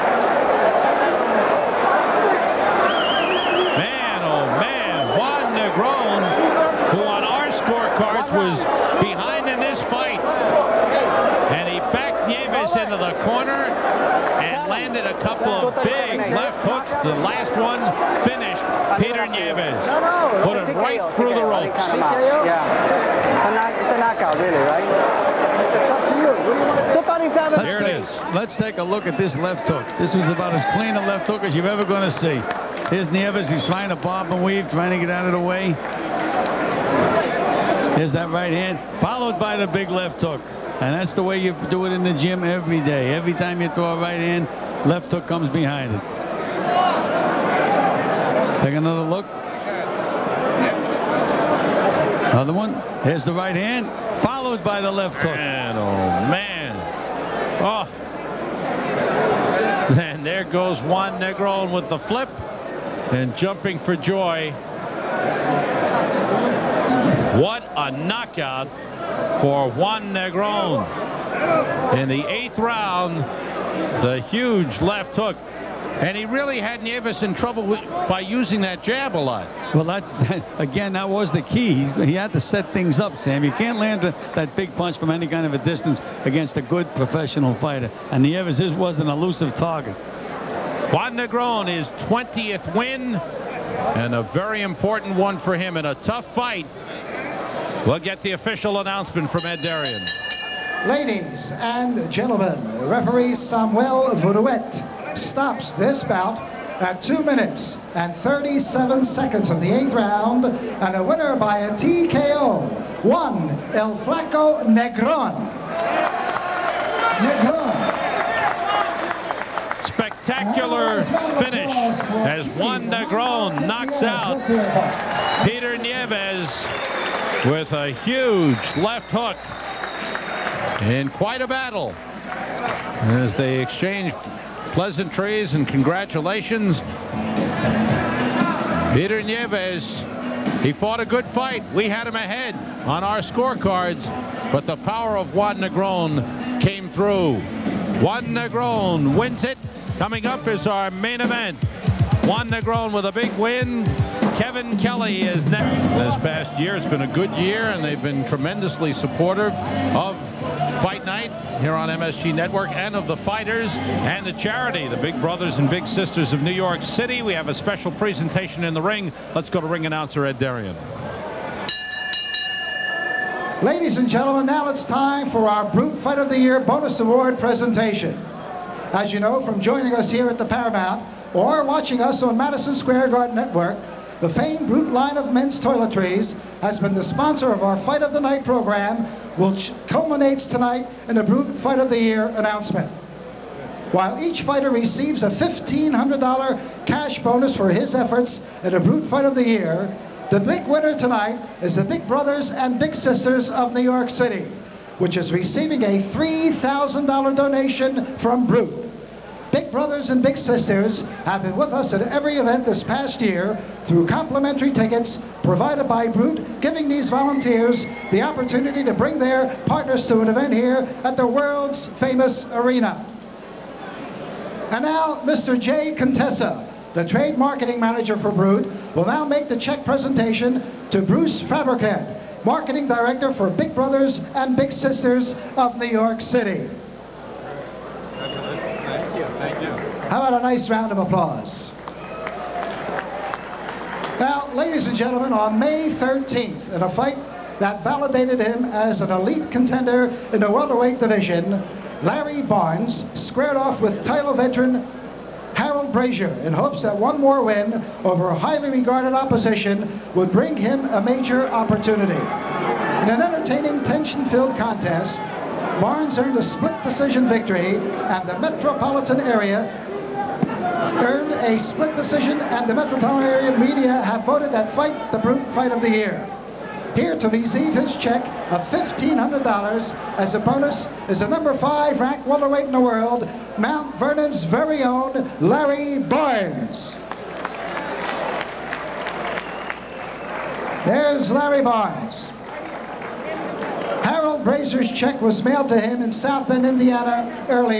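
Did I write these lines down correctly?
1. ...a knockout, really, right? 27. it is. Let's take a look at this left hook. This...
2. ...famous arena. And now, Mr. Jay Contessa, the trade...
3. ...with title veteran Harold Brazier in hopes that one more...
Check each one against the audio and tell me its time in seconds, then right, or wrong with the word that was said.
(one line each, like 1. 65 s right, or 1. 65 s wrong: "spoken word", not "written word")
1. 23 s right
2. 221 s right
3. 253 s right.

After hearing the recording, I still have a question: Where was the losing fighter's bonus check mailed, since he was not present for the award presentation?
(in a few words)
South Bend, Indiana.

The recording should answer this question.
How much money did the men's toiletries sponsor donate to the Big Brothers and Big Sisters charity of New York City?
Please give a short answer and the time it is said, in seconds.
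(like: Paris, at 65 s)
$3,000, at 206 s.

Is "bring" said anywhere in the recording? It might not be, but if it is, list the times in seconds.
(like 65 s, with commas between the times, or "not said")
218 s, 260 s.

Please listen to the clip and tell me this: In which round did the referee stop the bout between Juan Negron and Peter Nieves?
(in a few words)
8th.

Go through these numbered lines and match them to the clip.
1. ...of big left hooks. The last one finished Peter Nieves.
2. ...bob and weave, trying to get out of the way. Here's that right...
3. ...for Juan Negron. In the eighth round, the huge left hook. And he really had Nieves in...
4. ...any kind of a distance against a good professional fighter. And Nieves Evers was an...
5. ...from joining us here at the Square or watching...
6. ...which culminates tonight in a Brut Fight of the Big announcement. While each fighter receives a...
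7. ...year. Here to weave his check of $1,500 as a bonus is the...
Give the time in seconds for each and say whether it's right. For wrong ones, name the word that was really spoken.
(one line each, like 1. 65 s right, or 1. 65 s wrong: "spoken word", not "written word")
1. 15 s right
2. 33 s right
3. 69 s right
4. 85 s right
5. 179 s wrong: "Paramount", not "Square"
6. 189 s wrong: "Year", not "Big"
7. 275 s wrong: "receive", not "weave".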